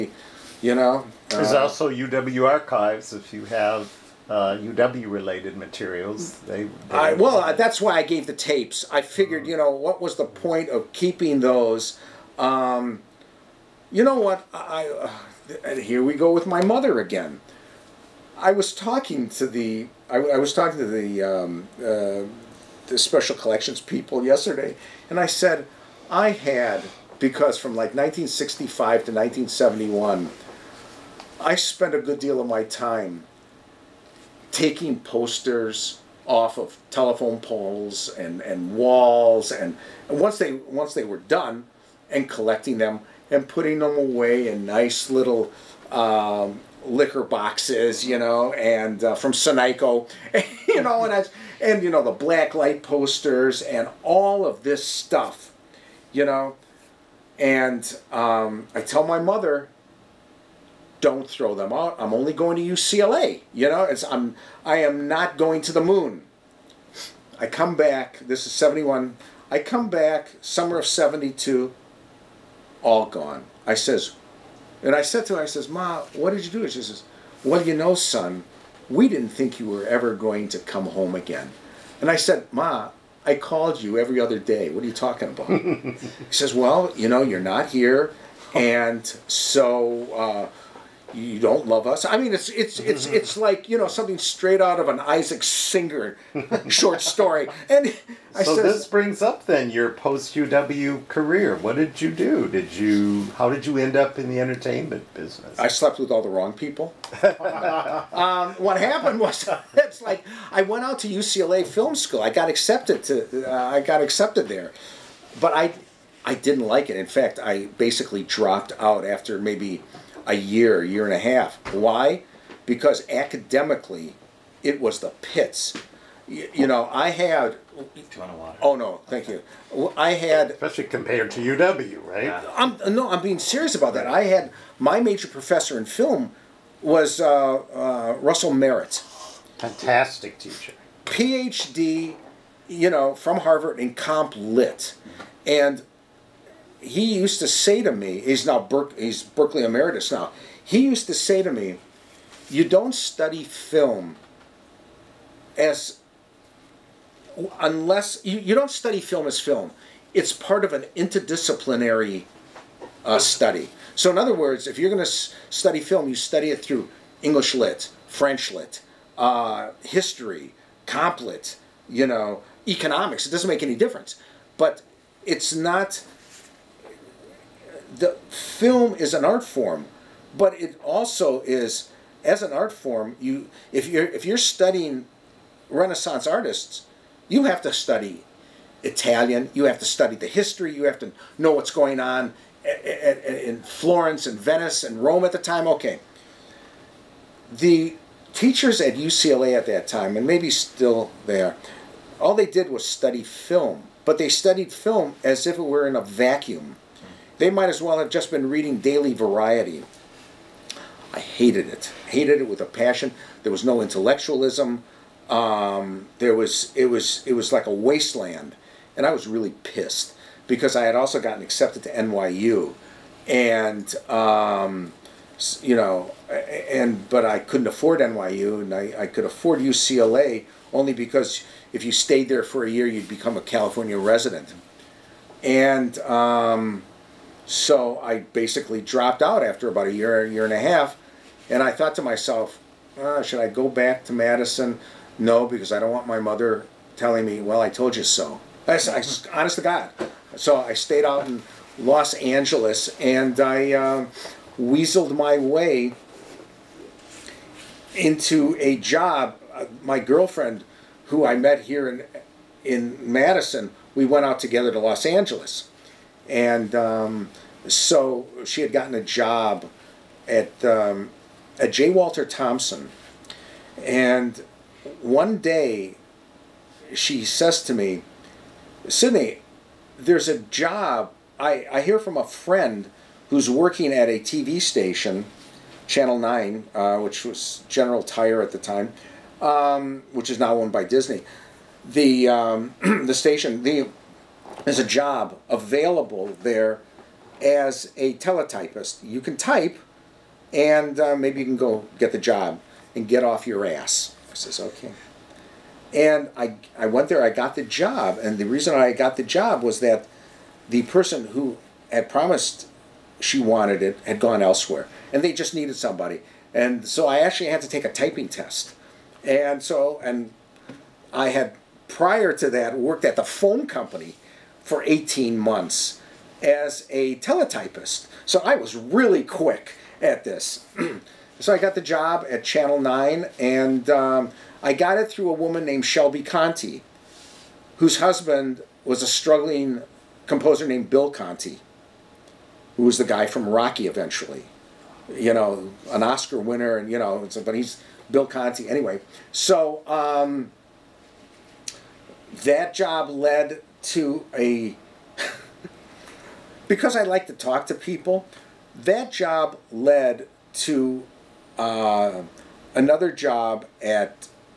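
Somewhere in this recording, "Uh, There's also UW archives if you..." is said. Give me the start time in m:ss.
0:01.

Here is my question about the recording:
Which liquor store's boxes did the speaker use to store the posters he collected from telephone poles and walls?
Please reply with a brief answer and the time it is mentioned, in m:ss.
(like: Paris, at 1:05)
Sanico, at 0:49.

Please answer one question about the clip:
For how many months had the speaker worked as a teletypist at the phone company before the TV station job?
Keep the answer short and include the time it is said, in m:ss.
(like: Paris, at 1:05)
18, at 5:24.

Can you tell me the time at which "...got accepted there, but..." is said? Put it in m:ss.
1:53.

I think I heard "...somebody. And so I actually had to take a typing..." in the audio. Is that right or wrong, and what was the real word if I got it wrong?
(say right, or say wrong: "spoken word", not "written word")
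right.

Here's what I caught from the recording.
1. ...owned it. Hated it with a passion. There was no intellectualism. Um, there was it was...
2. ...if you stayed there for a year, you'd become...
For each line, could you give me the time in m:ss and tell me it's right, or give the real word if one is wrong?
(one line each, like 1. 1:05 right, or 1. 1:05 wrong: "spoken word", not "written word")
1. 3:31 wrong: "hated", not "owned"
2. 3:51 right.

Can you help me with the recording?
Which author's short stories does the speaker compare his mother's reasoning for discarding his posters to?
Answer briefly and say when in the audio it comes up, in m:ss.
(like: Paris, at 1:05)
Isaac Singer, at 1:34.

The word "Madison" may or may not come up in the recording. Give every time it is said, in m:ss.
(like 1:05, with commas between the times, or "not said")
4:04, 4:22.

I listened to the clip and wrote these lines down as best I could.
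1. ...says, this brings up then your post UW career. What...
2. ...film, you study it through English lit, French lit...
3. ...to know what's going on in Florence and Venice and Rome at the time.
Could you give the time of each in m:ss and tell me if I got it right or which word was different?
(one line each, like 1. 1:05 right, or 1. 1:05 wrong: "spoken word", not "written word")
1. 1:38 right
2. 2:45 right
3. 3:10 right.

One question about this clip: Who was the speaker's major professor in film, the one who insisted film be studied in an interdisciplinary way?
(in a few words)
Russell Merritt.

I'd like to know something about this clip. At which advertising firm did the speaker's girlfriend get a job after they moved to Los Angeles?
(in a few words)
J. Walter Thompson.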